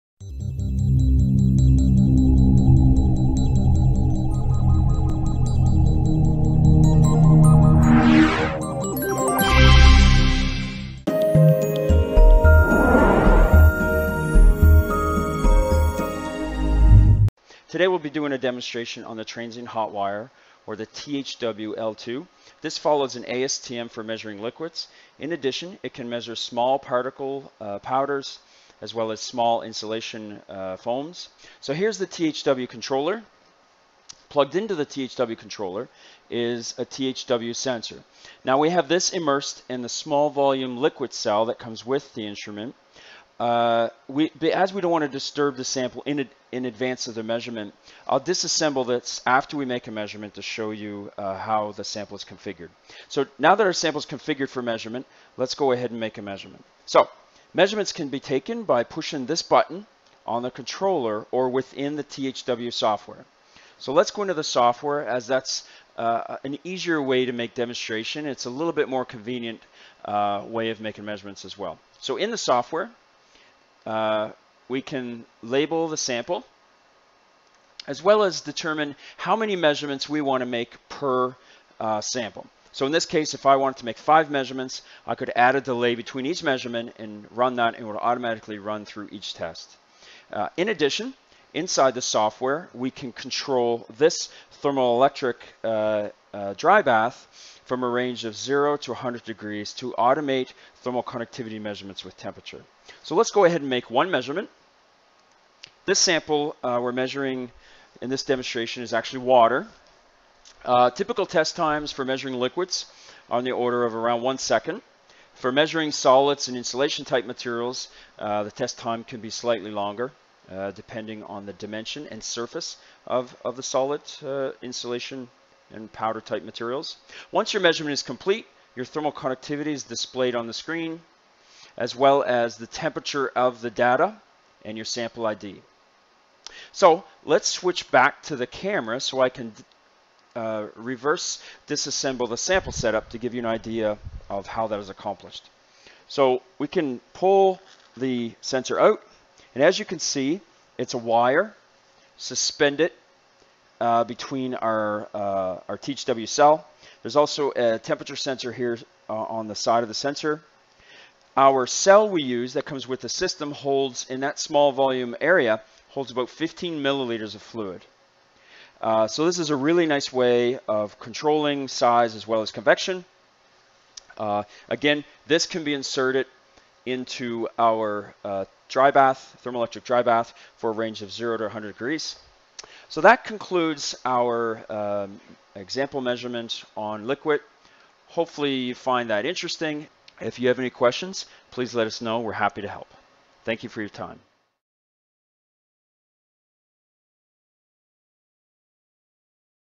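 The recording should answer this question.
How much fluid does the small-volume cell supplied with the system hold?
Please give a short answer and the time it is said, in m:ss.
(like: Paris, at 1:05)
15 milliliters, at 2:46.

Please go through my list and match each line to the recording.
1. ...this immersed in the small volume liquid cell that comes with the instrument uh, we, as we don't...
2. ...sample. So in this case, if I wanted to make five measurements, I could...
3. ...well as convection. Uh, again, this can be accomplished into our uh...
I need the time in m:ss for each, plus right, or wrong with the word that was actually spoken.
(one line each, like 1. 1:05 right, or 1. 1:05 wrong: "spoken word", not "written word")
1. 0:38 right
2. 1:21 right
3. 2:52 wrong: "inserted", not "accomplished".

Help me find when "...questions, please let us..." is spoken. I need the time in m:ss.
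3:10.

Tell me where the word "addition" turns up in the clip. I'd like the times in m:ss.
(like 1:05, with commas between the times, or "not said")
0:25, 1:30.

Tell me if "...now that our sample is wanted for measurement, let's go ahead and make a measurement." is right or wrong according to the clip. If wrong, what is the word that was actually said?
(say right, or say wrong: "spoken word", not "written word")
wrong: "configured", not "wanted".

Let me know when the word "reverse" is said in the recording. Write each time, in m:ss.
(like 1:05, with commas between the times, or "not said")
2:20.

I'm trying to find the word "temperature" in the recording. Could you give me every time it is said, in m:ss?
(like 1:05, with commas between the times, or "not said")
1:42, 2:12, 2:37.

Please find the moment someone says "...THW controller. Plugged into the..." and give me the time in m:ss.
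0:32.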